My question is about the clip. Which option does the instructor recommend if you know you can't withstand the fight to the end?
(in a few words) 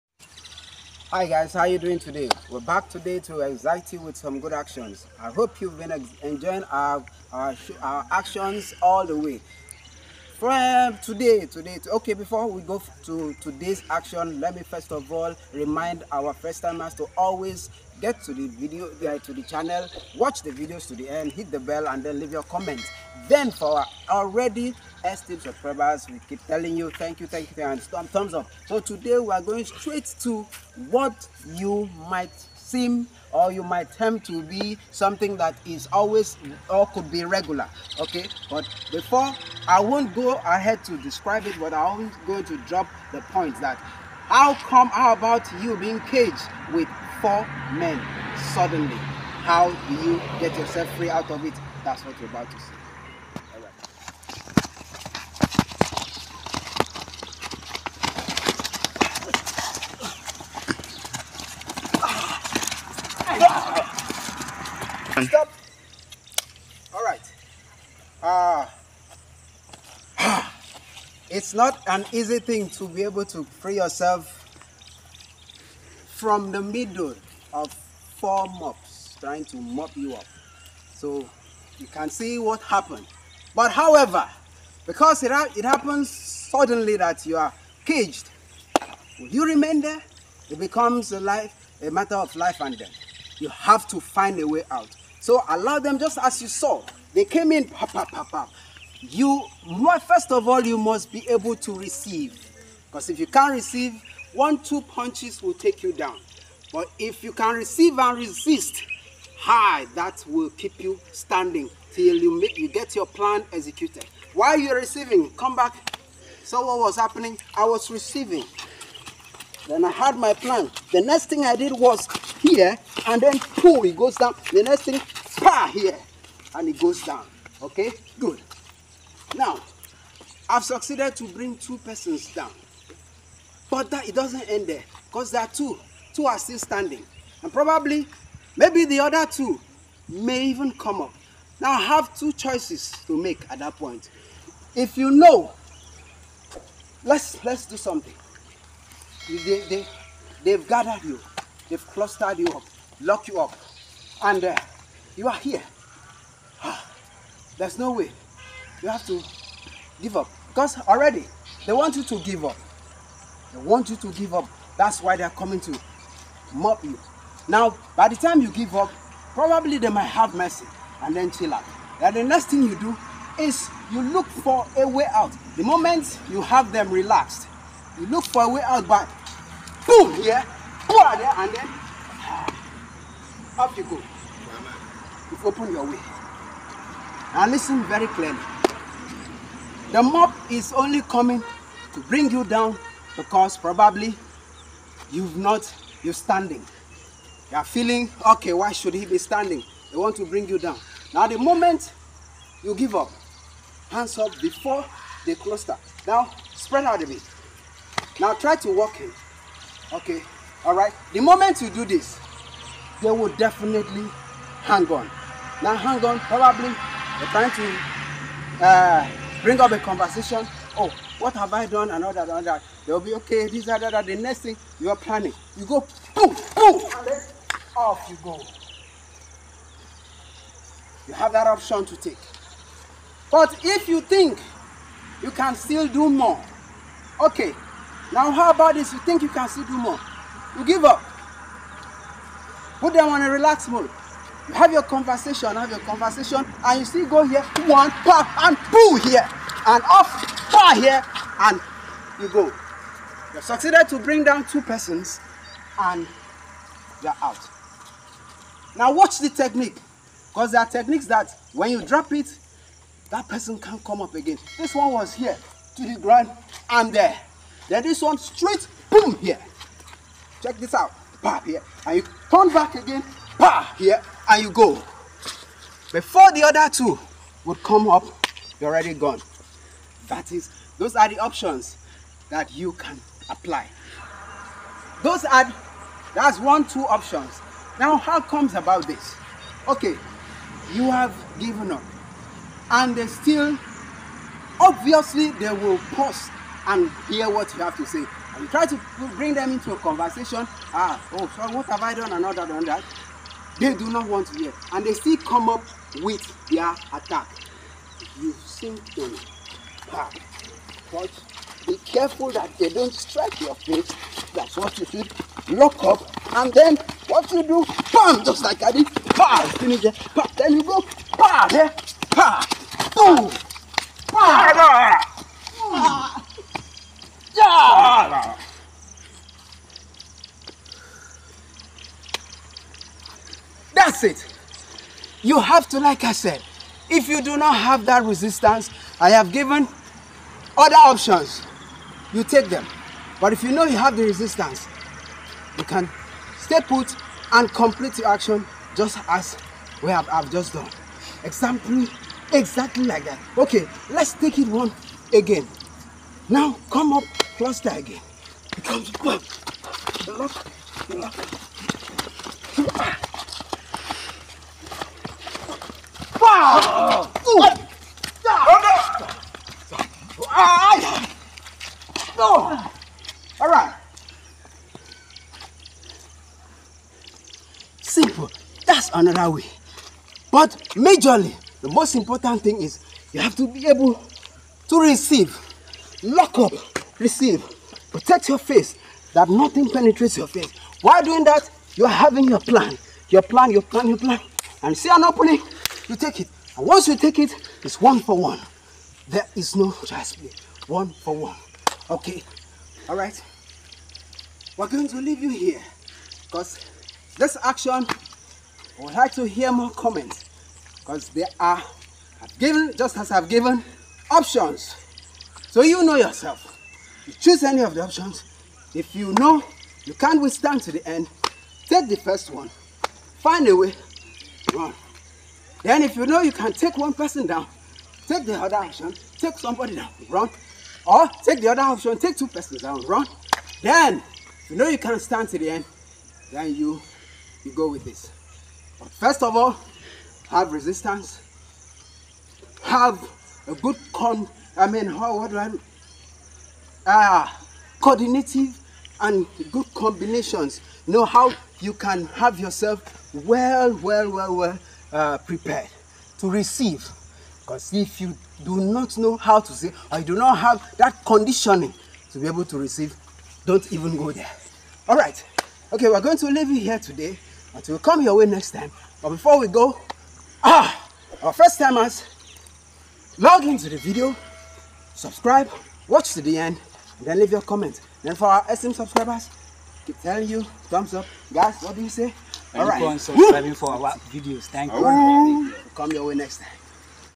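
The first one.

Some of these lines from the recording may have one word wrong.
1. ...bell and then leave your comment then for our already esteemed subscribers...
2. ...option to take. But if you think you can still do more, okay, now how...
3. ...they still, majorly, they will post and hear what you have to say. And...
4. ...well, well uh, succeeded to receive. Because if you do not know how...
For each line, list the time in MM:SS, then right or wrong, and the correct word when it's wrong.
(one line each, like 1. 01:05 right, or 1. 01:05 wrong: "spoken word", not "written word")
1. 00:21 right
2. 03:51 right
3. 04:52 wrong: "obviously", not "majorly"
4. 07:34 wrong: "prepared", not "succeeded".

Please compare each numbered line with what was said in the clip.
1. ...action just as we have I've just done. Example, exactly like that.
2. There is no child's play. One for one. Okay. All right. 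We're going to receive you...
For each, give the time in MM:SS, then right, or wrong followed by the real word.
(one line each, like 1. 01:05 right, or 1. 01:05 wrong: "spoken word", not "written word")
1. 05:48 right
2. 06:39 wrong: "leave", not "receive".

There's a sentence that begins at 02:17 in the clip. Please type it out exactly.
And probably, maybe the other two may even come up.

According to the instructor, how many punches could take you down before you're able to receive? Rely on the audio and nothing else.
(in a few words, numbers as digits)
1 or 2.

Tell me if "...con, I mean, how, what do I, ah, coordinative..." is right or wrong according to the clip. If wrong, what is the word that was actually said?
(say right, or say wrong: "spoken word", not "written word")
right.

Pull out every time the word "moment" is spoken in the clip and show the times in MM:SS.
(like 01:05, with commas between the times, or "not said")
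02:55, 03:21, 03:31.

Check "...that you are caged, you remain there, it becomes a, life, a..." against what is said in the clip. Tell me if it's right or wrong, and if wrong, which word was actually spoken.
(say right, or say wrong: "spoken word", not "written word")
right.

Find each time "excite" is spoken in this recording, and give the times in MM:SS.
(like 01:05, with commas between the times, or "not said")
00:03.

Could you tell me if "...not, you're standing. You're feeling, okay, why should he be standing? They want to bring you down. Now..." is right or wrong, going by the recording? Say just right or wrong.
right.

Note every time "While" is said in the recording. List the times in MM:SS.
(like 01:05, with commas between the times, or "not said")
01:54, 06:30.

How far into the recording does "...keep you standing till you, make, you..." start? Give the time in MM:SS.
01:50.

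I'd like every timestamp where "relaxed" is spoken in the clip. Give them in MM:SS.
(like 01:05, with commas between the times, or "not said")
02:56, 04:03.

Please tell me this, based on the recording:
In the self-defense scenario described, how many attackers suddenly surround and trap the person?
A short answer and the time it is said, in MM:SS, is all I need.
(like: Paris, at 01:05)
4, at 00:47.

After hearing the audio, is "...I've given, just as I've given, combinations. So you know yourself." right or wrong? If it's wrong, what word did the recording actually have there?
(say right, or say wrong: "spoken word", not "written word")
wrong: "options", not "combinations".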